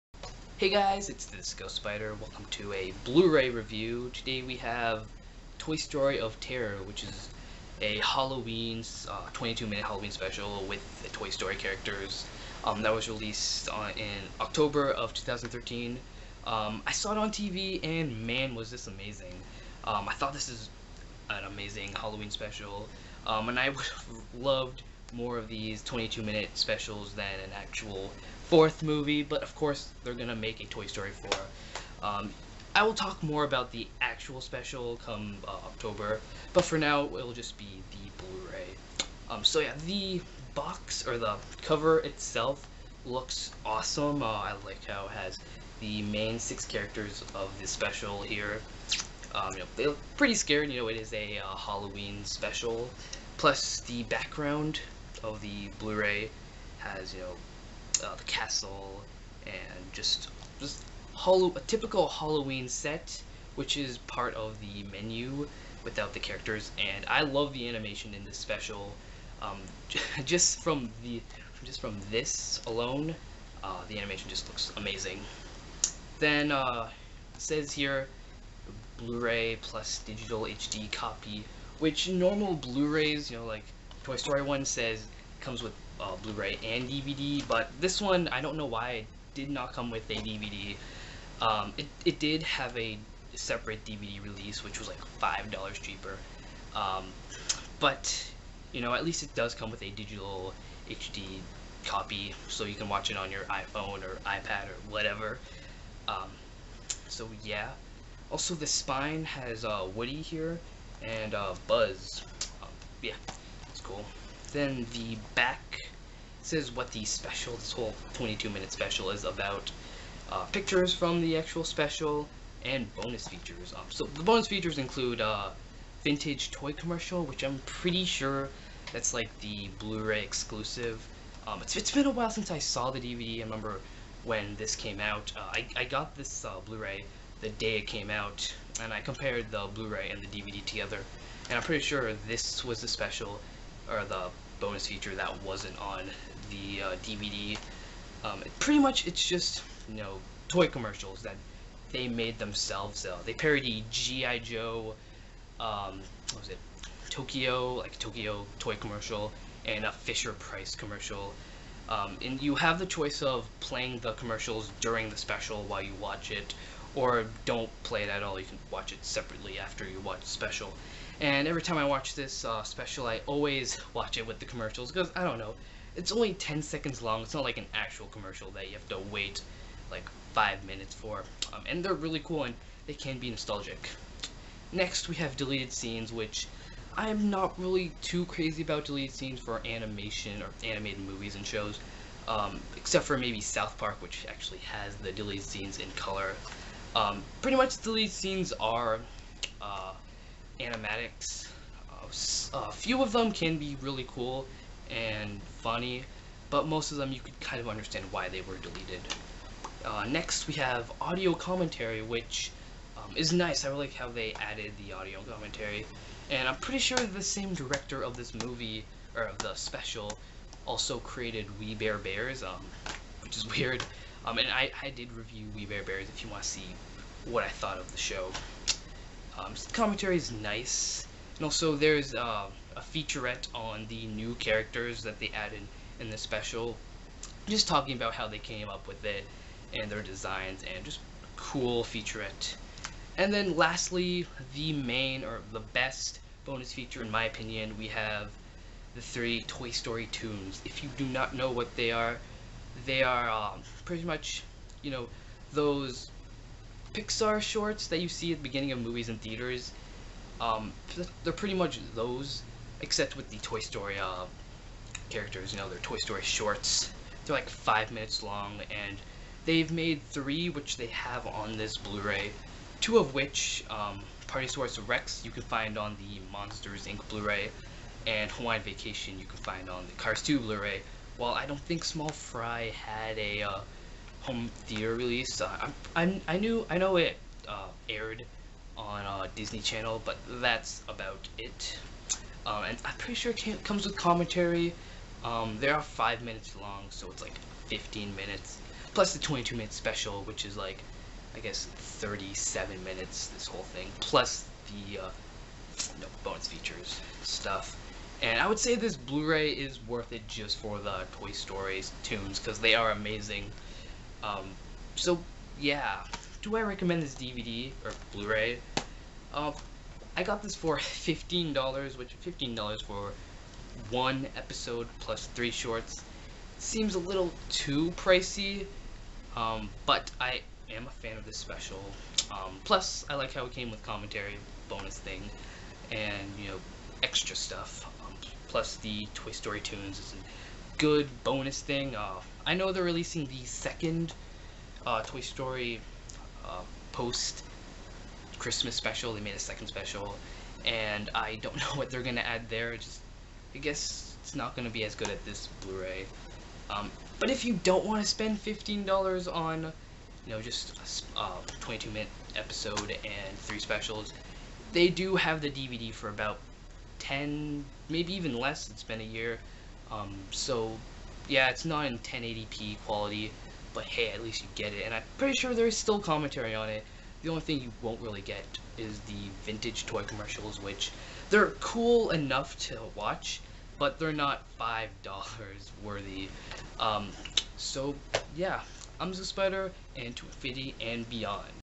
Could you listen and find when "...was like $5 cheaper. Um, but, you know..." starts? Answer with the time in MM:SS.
01:34.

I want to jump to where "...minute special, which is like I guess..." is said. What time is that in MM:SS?
04:59.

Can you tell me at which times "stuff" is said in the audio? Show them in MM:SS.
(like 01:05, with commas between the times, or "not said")
05:07, 05:37.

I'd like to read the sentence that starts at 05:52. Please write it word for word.
just I guess it's not gonna be as good at this Blu-ray.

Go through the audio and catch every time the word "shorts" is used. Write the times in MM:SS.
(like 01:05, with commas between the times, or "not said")
04:17, 04:26, 05:25.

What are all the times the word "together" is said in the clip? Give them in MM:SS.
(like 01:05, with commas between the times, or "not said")
02:20.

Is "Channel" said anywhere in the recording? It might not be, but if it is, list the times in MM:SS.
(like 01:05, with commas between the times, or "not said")
04:49.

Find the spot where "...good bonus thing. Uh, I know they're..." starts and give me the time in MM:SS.
05:40.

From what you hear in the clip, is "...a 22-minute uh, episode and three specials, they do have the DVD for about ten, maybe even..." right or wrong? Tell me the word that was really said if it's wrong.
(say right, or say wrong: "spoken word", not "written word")
right.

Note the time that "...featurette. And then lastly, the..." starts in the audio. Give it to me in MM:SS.
04:01.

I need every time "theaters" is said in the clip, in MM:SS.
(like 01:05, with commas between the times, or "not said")
04:19, 04:44.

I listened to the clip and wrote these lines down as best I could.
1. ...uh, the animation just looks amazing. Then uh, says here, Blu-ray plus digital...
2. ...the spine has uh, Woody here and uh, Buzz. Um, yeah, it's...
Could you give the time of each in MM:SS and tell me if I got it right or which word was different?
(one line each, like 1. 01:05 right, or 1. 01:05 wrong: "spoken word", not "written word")
1. 01:13 right
2. 01:48 right.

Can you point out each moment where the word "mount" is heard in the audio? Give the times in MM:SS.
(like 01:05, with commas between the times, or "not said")
not said.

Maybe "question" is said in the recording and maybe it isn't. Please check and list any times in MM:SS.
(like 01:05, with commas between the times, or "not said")
not said.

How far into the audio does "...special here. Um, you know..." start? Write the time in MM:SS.
00:47.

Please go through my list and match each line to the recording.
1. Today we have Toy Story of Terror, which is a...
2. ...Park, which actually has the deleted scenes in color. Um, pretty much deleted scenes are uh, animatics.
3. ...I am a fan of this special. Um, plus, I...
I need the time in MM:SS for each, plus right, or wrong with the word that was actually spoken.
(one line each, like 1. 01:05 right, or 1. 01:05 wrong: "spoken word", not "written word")
1. 00:04 right
2. 03:13 right
3. 05:30 right.